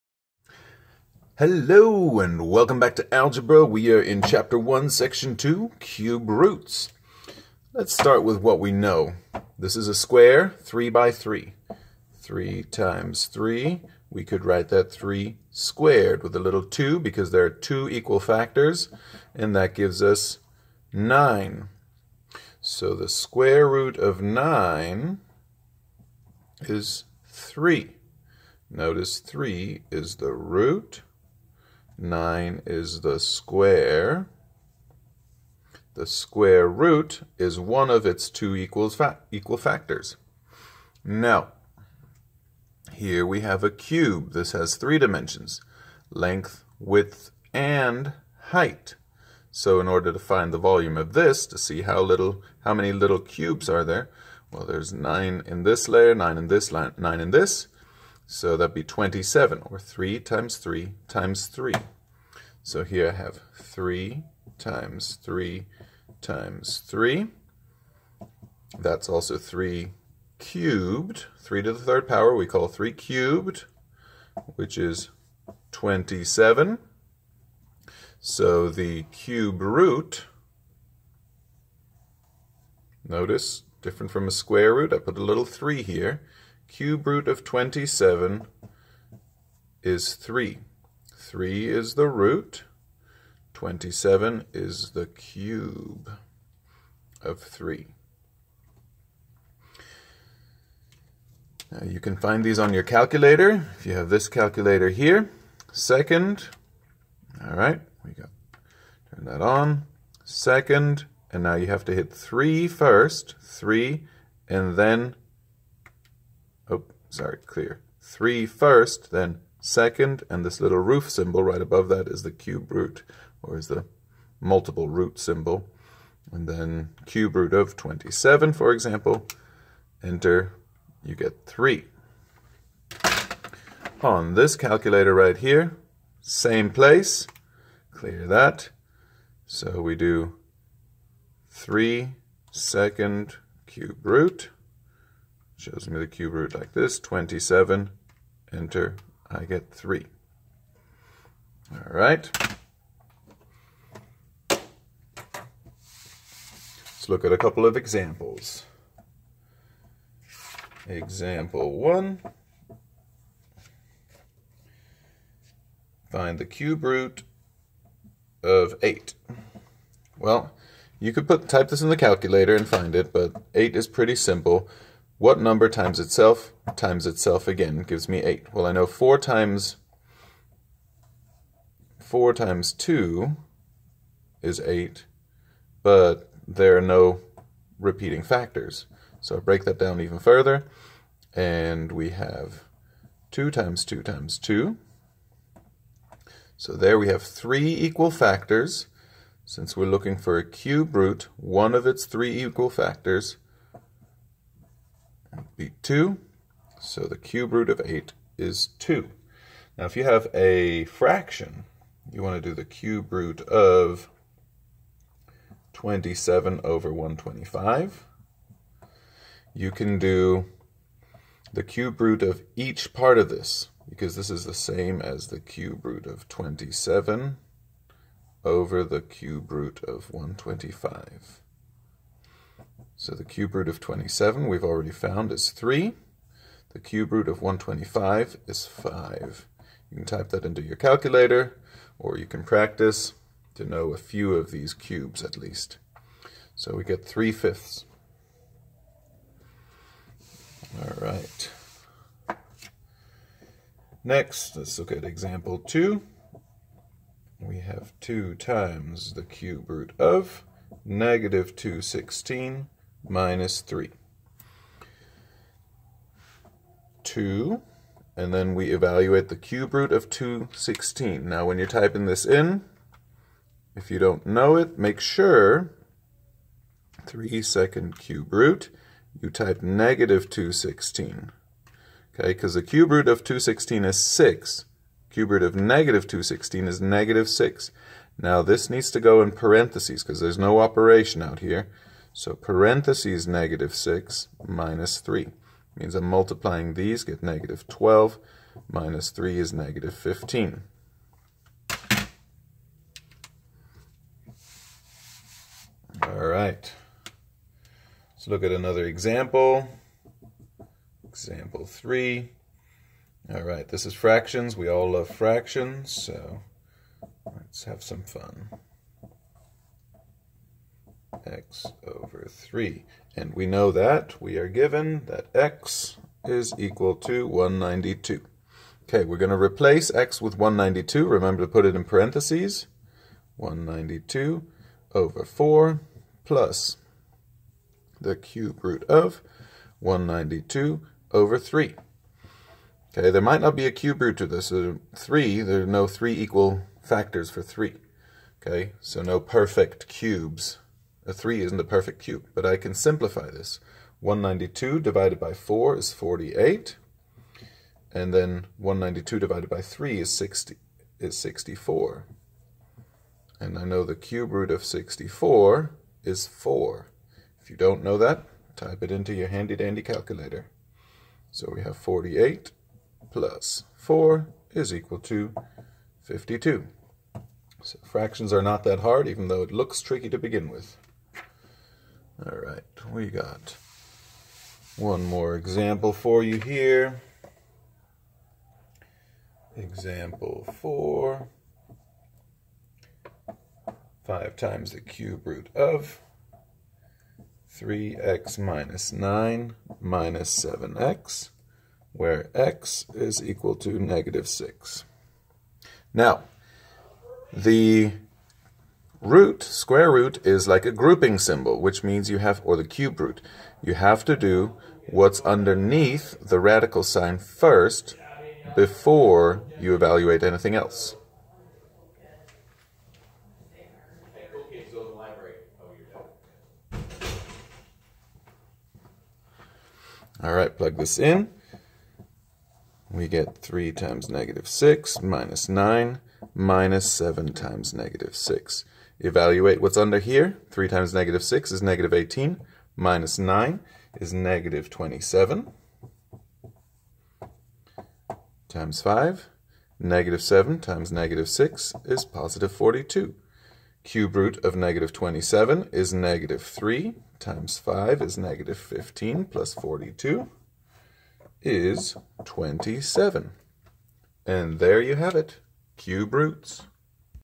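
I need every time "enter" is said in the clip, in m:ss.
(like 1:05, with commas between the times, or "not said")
2:10, 2:28.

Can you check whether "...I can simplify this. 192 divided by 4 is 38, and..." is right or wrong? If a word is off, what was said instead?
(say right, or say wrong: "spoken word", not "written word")
wrong: "48", not "38".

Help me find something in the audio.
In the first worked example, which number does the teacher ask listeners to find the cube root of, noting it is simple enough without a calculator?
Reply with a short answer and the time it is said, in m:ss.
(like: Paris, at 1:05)
8, at 2:46.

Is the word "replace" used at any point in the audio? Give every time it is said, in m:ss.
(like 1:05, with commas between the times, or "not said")
5:29.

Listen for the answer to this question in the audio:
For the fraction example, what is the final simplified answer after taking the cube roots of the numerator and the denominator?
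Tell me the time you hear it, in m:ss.
4:07.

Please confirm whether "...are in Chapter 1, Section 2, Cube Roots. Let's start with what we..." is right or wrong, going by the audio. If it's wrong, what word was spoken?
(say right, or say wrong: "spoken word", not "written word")
right.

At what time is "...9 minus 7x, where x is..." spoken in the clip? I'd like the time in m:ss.
6:38.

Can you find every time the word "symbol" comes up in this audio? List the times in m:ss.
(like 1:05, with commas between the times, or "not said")
2:01, 2:05, 6:51.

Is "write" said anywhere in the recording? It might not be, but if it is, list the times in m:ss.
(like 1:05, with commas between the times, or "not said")
0:14.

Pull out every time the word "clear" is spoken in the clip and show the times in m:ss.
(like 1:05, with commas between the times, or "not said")
1:57, 2:17.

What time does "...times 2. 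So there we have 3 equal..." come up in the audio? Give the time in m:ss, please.
3:14.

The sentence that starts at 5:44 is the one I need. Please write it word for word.
3, there are no 3 equal factors for 3.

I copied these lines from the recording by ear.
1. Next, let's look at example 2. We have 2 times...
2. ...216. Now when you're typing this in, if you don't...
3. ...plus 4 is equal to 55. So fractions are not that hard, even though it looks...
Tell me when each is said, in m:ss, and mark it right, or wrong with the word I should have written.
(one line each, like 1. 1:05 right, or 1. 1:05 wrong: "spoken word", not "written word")
1. 4:14 right
2. 4:30 right
3. 6:13 wrong: "52", not "55".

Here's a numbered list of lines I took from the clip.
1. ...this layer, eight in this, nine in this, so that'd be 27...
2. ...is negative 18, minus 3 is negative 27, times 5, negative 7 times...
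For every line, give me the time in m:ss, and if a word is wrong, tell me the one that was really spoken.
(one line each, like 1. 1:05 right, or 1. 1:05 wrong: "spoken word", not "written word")
1. 0:55 wrong: "nine", not "eight"
2. 7:21 wrong: "9", not "3".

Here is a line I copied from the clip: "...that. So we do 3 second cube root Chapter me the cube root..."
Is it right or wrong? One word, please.
wrong.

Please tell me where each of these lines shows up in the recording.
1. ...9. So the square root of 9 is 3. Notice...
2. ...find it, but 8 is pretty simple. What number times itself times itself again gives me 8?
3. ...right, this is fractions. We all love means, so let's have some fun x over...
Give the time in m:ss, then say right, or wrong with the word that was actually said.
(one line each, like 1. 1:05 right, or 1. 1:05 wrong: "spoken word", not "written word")
1. 0:20 right
2. 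2:52 right
3. 5:13 wrong: "fractions", not "means".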